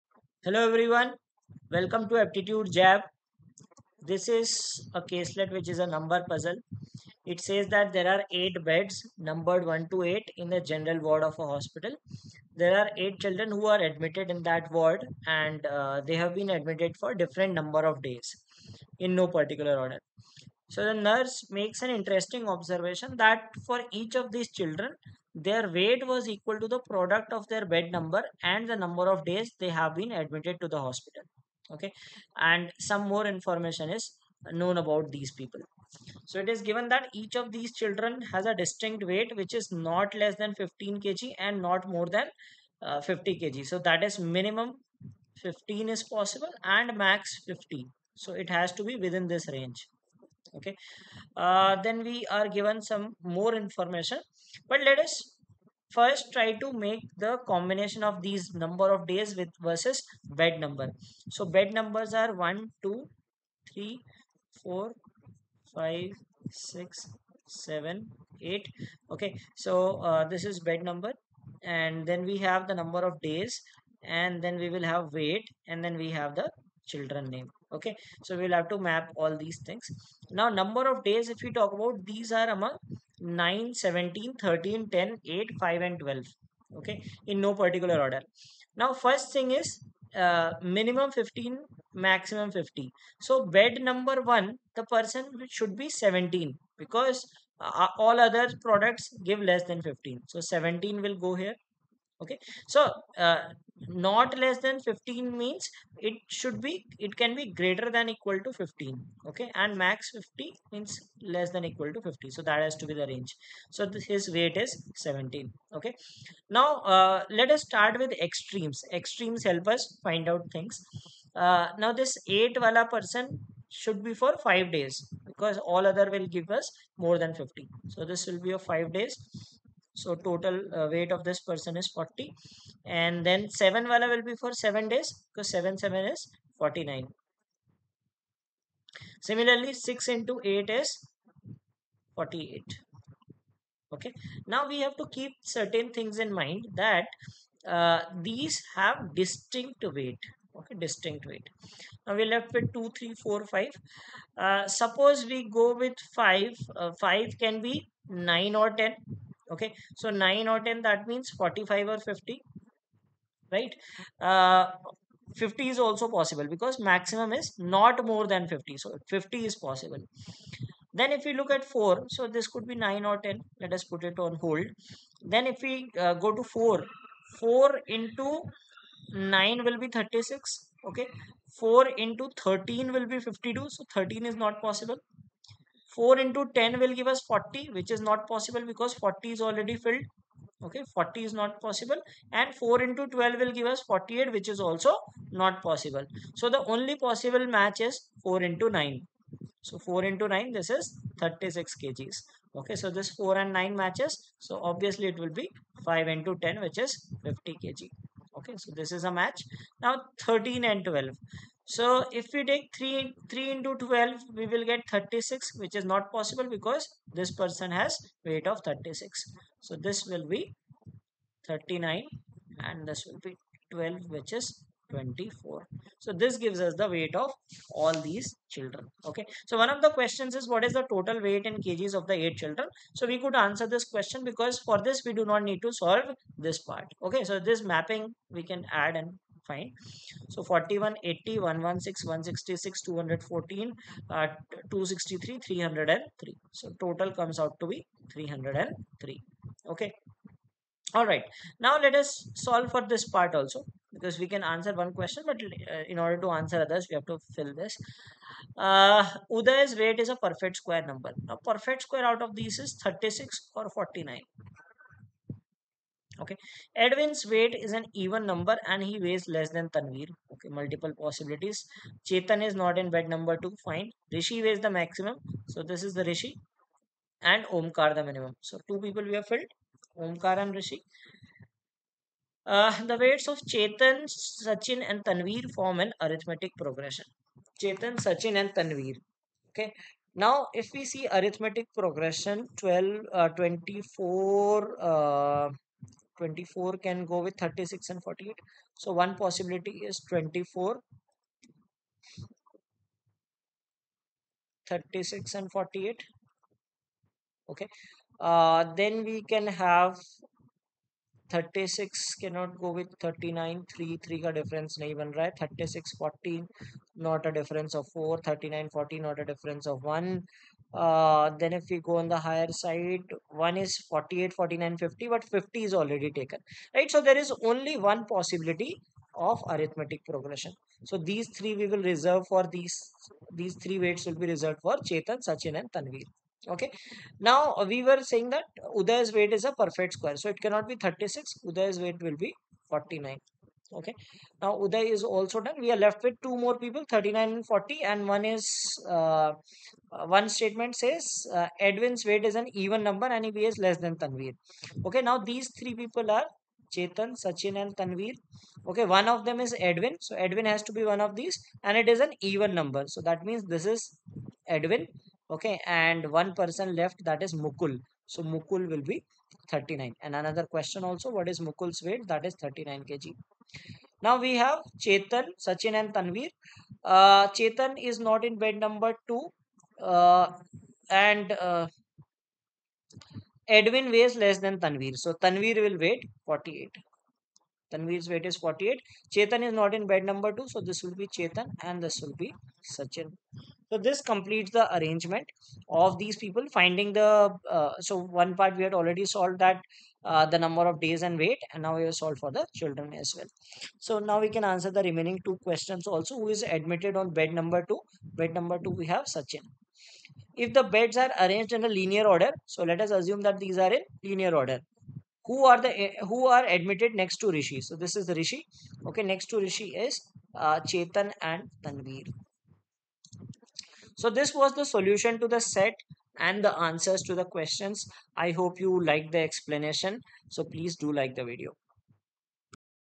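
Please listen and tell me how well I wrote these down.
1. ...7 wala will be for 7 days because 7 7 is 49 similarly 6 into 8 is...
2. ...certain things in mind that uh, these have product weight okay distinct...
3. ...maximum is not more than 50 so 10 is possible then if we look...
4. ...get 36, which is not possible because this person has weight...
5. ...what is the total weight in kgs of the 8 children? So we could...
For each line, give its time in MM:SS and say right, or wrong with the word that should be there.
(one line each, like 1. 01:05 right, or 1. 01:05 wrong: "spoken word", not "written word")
1. 02:13 right
2. 02:25 wrong: "distinct", not "product"
3. 02:46 wrong: "50", not "10"
4. 03:34 right
5. 03:50 right.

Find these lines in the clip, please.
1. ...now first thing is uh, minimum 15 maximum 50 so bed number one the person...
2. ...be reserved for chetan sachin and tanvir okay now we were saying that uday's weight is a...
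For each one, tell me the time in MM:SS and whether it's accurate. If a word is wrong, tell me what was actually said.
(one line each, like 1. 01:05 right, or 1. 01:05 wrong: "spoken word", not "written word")
1. 01:28 right
2. 05:34 right.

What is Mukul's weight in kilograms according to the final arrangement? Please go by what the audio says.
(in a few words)
39.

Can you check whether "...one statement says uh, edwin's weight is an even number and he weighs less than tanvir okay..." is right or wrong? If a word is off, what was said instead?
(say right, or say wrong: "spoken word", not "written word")
right.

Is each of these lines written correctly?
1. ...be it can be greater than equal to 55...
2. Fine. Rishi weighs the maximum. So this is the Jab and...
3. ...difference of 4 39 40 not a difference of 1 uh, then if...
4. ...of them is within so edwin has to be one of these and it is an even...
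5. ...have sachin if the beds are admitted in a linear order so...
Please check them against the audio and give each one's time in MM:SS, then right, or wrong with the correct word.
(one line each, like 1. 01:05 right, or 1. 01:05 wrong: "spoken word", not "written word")
1. 01:46 wrong: "15", not "55"
2. 04:33 wrong: "Rishi", not "Jab"
3. 05:17 right
4. 05:59 wrong: "edwin", not "within"
5. 06:48 wrong: "arranged", not "admitted".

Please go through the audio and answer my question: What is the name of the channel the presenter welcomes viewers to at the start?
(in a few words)
Aptitude Jab.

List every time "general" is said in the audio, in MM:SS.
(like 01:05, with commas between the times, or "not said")
00:10.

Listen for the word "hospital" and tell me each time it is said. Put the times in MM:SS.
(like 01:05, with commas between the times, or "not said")
00:11, 00:30.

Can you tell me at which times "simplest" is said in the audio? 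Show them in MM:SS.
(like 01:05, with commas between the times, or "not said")
not said.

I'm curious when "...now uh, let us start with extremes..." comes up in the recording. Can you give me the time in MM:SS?
01:56.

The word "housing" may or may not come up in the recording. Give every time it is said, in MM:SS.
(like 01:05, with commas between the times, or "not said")
not said.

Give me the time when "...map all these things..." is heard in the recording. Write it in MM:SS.
01:18.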